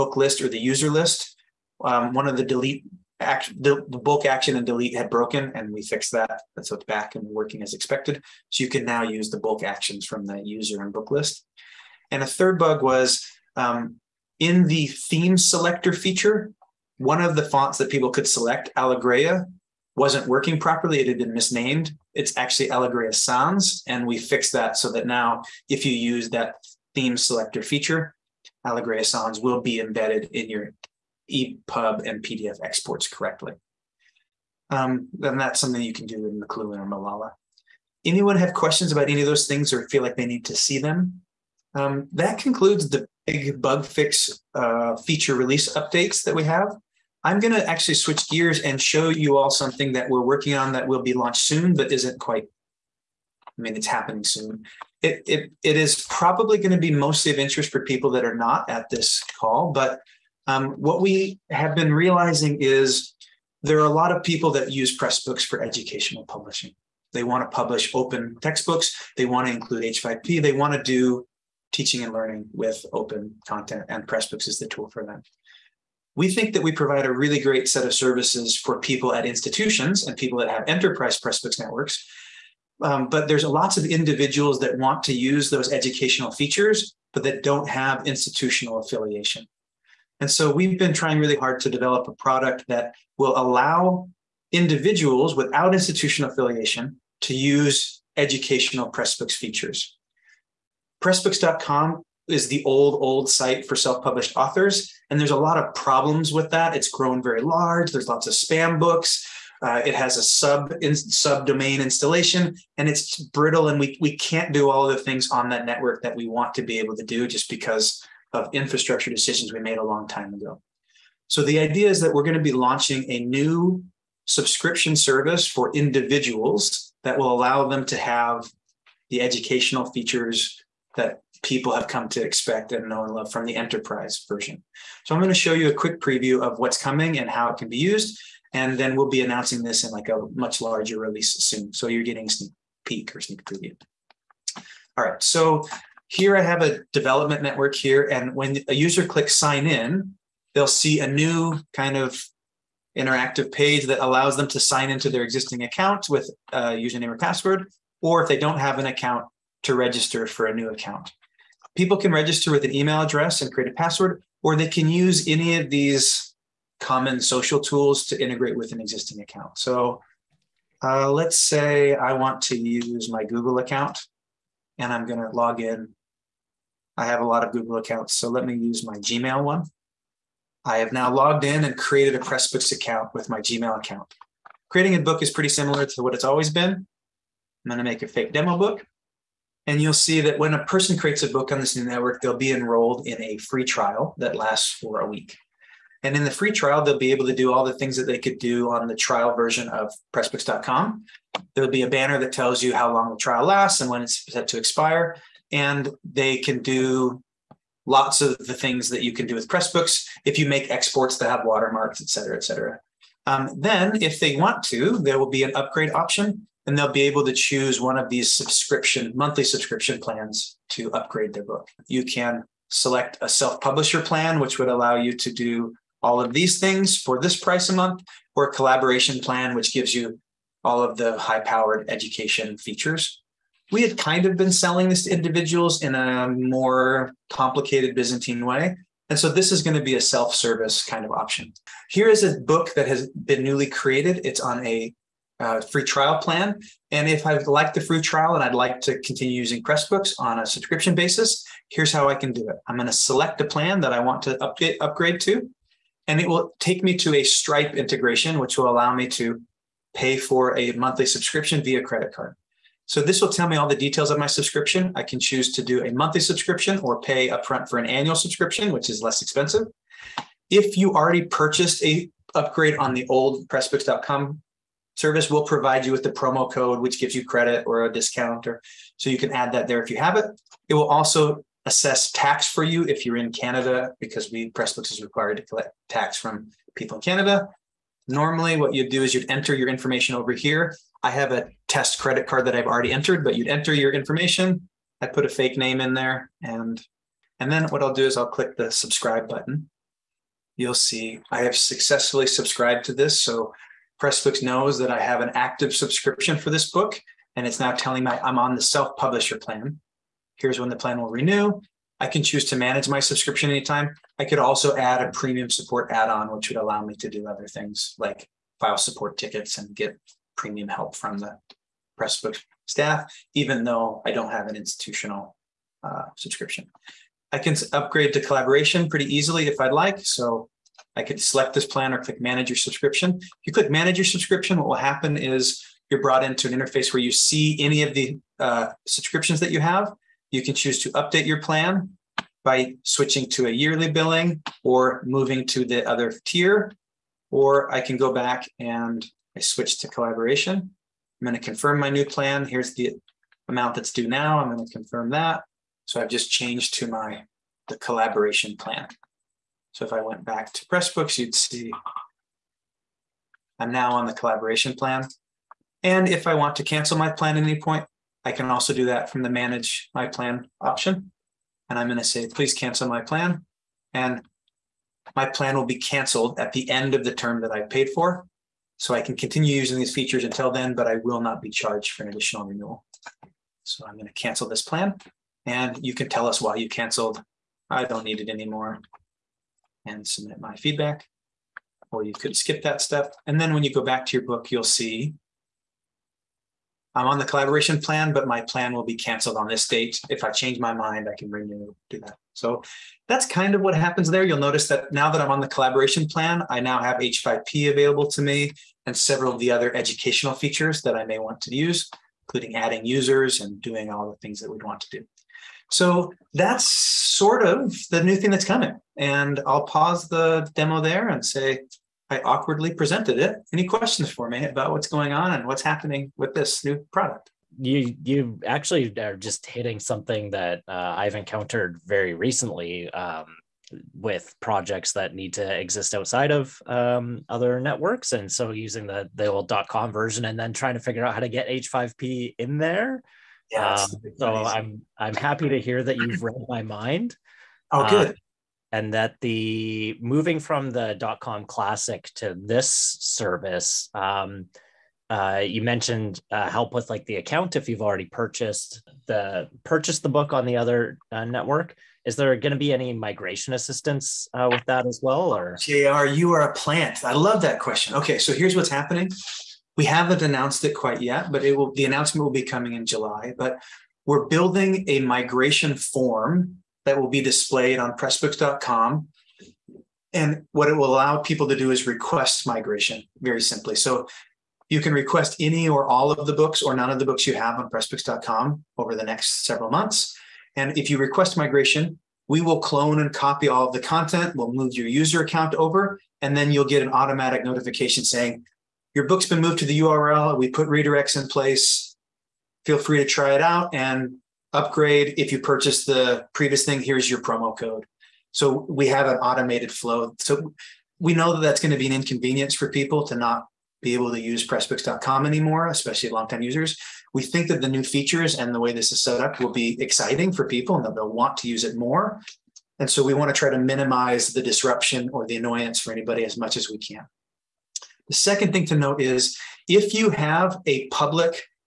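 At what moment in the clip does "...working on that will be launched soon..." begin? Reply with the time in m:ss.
0:50.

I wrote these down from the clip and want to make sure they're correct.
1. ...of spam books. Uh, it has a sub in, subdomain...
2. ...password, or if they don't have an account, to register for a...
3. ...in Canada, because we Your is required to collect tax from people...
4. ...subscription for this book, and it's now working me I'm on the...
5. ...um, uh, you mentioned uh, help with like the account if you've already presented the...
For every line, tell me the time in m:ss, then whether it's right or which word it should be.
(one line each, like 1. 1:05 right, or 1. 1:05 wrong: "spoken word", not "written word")
1. 1:48 right
2. 2:37 right
3. 4:43 wrong: "Pressbooks", not "Your"
4. 5:05 wrong: "telling", not "working"
5. 7:33 wrong: "purchased", not "presented".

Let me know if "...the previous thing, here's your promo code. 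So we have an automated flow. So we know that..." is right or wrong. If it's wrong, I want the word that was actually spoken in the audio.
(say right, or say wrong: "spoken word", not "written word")
right.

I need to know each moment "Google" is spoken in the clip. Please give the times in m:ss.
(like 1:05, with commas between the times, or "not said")
2:53, 2:57.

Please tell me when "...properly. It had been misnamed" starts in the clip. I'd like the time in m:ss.
0:20.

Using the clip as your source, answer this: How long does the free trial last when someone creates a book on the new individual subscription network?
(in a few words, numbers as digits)
a week.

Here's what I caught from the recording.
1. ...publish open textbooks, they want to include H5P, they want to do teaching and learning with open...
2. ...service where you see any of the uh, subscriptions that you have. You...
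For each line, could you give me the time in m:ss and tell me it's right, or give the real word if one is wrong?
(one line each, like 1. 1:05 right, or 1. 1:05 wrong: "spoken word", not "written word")
1. 1:07 right
2. 5:36 wrong: "interface", not "service".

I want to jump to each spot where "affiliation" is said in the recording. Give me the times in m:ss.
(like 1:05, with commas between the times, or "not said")
1:28, 1:36.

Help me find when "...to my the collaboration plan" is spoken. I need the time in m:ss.
5:56.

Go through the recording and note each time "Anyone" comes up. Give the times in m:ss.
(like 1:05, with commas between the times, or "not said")
0:38.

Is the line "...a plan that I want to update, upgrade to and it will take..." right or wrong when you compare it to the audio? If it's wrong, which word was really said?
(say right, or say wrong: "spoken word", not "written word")
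right.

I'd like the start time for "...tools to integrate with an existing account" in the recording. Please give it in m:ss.
2:47.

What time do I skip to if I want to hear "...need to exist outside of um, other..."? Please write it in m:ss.
7:15.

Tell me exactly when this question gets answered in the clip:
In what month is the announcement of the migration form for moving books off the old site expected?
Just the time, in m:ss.
7:52.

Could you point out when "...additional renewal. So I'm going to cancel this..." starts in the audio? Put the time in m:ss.
6:22.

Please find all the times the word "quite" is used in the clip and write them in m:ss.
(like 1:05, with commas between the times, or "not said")
0:52, 7:50.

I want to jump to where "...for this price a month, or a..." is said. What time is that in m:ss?
3:47.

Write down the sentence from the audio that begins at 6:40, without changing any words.
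If I change my mind, I can renew, do that.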